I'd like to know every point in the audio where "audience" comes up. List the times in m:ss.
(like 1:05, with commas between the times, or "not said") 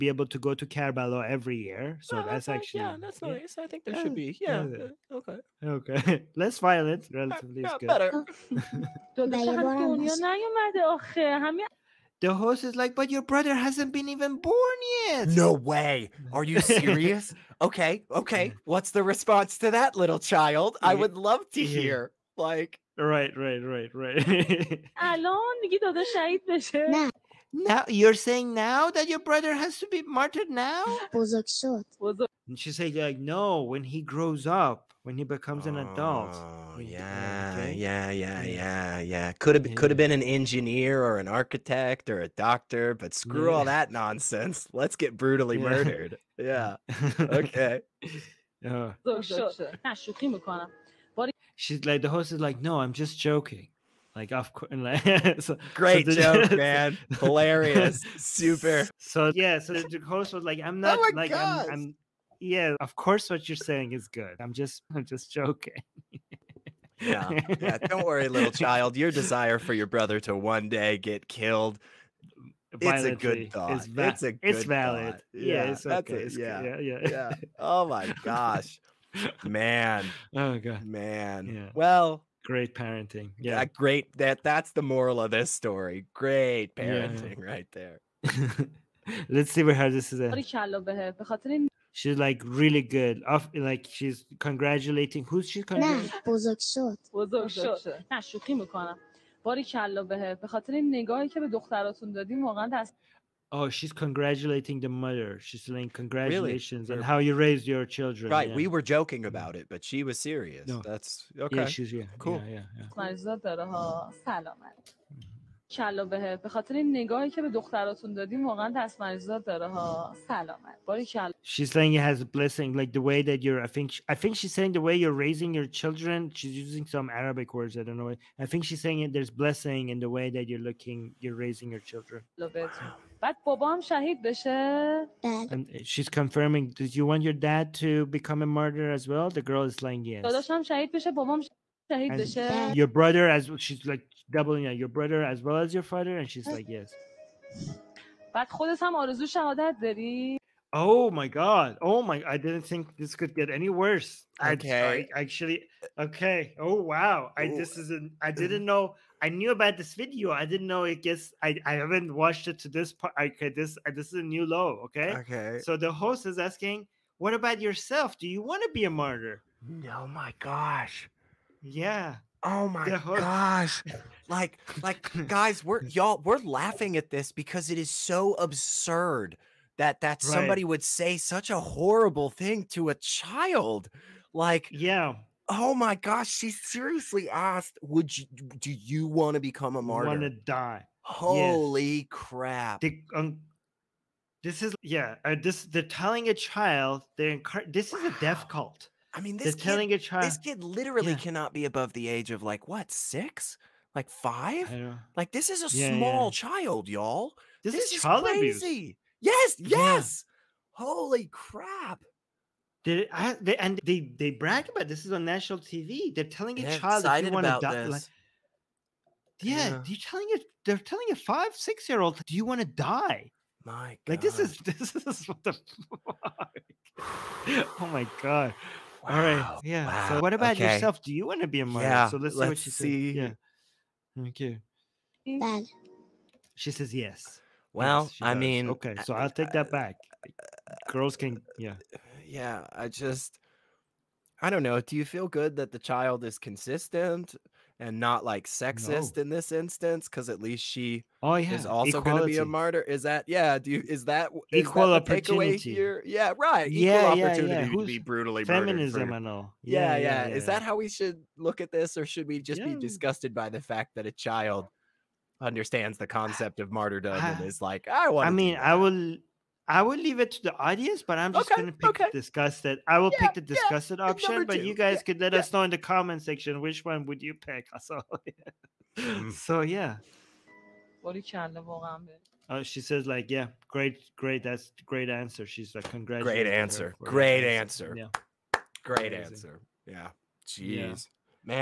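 4:30.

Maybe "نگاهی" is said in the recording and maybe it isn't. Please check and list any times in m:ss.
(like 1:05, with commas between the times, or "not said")
1:40, 1:56.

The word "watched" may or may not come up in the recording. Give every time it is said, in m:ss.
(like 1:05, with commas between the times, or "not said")
2:42.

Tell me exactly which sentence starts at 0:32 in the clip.
And she said, like, no, when he grows up, when he becomes an adult.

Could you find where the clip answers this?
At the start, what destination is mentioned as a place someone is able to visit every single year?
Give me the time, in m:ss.
0:00.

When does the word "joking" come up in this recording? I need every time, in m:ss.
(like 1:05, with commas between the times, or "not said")
0:53, 1:05, 1:48.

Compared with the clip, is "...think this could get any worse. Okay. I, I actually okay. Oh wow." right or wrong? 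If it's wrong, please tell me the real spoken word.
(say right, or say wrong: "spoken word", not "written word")
right.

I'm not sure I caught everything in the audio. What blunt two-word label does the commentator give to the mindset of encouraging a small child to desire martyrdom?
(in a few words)
Death cult.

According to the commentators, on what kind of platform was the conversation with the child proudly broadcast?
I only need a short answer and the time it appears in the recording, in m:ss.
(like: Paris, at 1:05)
National TV, at 3:35.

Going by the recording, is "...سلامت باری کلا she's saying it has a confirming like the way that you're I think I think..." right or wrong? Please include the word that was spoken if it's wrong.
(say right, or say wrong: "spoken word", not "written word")
wrong: "blessing", not "confirming".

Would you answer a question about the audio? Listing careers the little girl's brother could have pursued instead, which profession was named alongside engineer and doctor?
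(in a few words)
Architect.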